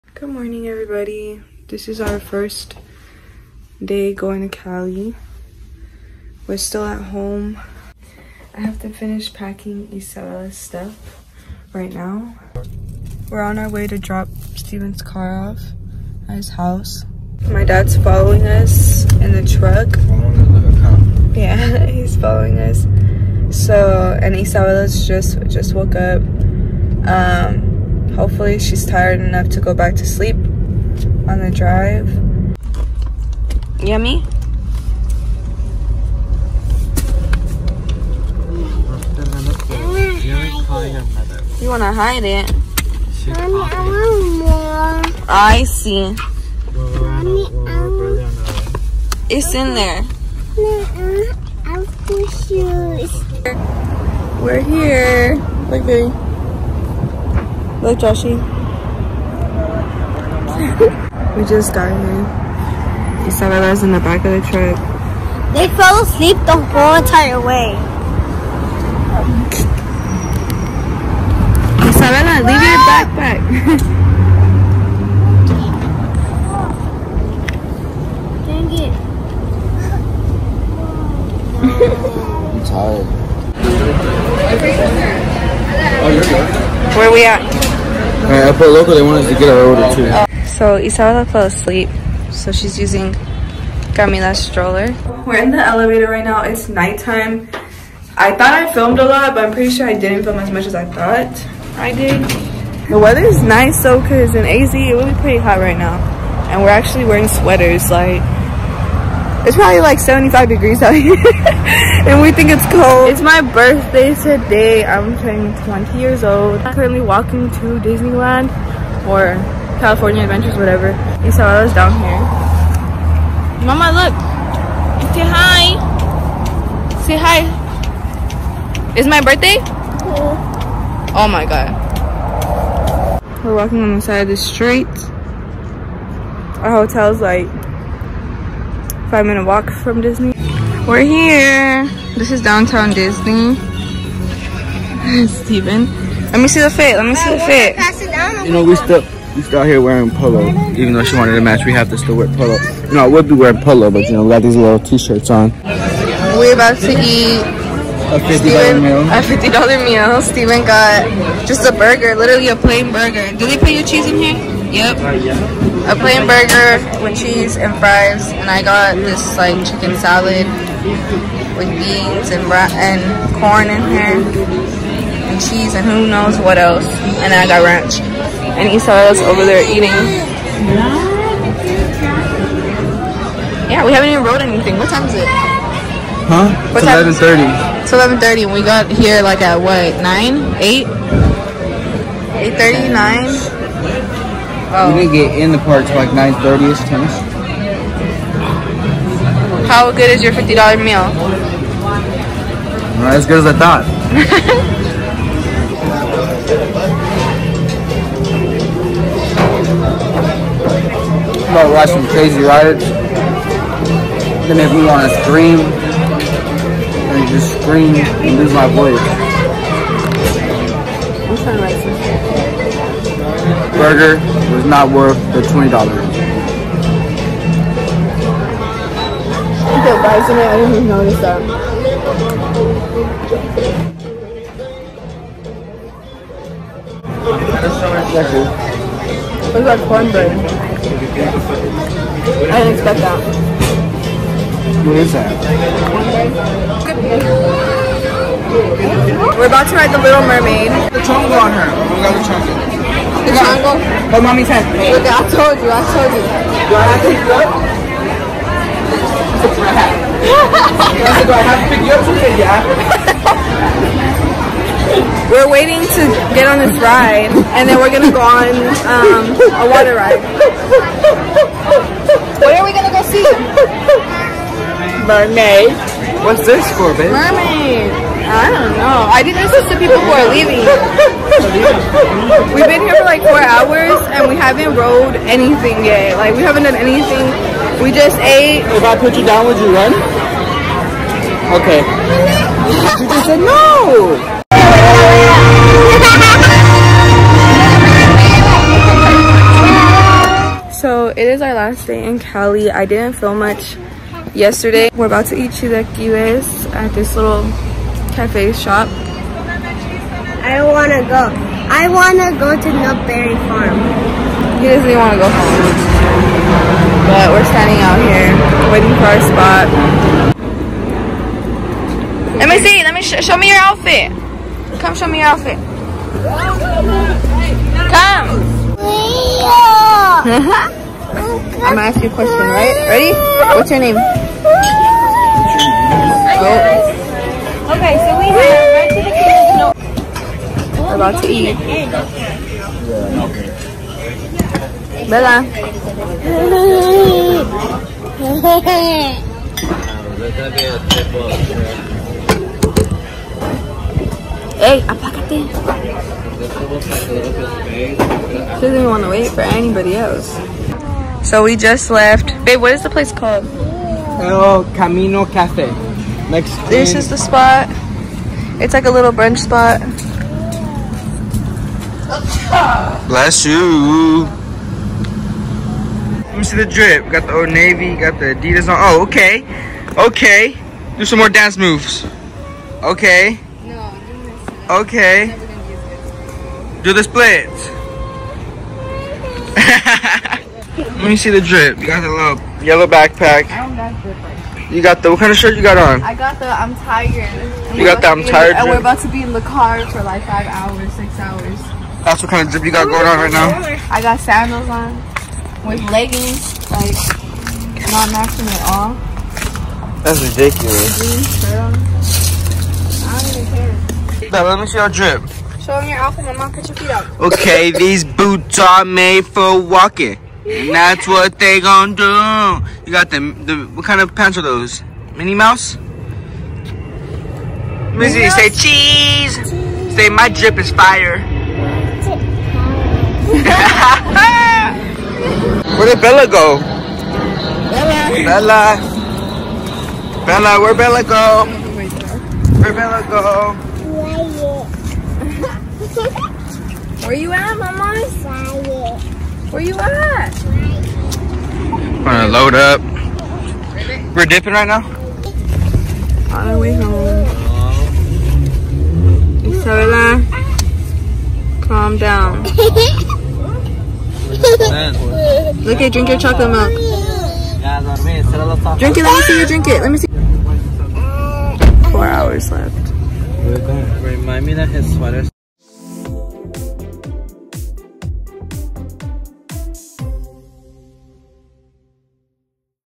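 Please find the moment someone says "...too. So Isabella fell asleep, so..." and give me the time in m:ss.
1:29.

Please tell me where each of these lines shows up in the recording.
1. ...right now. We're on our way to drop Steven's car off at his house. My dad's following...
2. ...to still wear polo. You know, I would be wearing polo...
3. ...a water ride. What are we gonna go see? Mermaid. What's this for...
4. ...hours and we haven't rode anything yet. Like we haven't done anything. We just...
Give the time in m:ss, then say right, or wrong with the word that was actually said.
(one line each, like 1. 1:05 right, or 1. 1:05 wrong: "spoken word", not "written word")
1. 0:11 right
2. 2:31 right
3. 4:29 right
4. 4:43 right.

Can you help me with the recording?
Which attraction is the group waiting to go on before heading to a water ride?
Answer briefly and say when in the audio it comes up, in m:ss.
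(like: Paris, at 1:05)
The Little Mermaid, at 4:09.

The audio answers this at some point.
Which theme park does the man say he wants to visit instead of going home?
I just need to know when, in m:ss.
5:12.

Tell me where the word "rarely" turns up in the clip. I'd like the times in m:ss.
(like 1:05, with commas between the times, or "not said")
not said.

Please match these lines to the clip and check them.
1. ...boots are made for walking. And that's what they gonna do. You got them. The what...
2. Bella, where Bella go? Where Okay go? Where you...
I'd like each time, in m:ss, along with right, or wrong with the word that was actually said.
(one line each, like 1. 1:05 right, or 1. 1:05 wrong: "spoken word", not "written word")
1. 6:58 right
2. 7:20 wrong: "Bella", not "Okay".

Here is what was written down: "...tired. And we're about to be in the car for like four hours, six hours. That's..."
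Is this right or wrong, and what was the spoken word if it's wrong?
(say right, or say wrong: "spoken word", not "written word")
wrong: "five", not "four".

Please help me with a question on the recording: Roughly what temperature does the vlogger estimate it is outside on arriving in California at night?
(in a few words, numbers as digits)
75 degrees.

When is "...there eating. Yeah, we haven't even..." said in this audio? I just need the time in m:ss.
2:59.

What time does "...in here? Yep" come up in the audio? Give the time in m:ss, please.
2:44.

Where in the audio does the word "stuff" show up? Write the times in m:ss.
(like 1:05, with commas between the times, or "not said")
0:10.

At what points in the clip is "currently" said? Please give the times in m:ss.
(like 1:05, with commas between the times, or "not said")
1:56.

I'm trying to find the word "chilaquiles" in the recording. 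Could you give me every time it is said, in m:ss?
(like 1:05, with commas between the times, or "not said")
5:05.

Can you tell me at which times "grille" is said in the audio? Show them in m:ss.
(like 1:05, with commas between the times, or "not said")
not said.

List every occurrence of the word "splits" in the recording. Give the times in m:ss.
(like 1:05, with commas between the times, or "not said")
6:27.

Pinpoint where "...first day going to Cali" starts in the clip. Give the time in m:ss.
0:02.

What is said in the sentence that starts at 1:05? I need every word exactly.
They fell asleep the whole entire way.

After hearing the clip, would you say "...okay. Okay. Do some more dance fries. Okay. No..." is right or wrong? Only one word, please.
wrong.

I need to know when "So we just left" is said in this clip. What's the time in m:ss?
6:01.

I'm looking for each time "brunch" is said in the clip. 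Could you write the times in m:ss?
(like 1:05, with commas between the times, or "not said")
6:09.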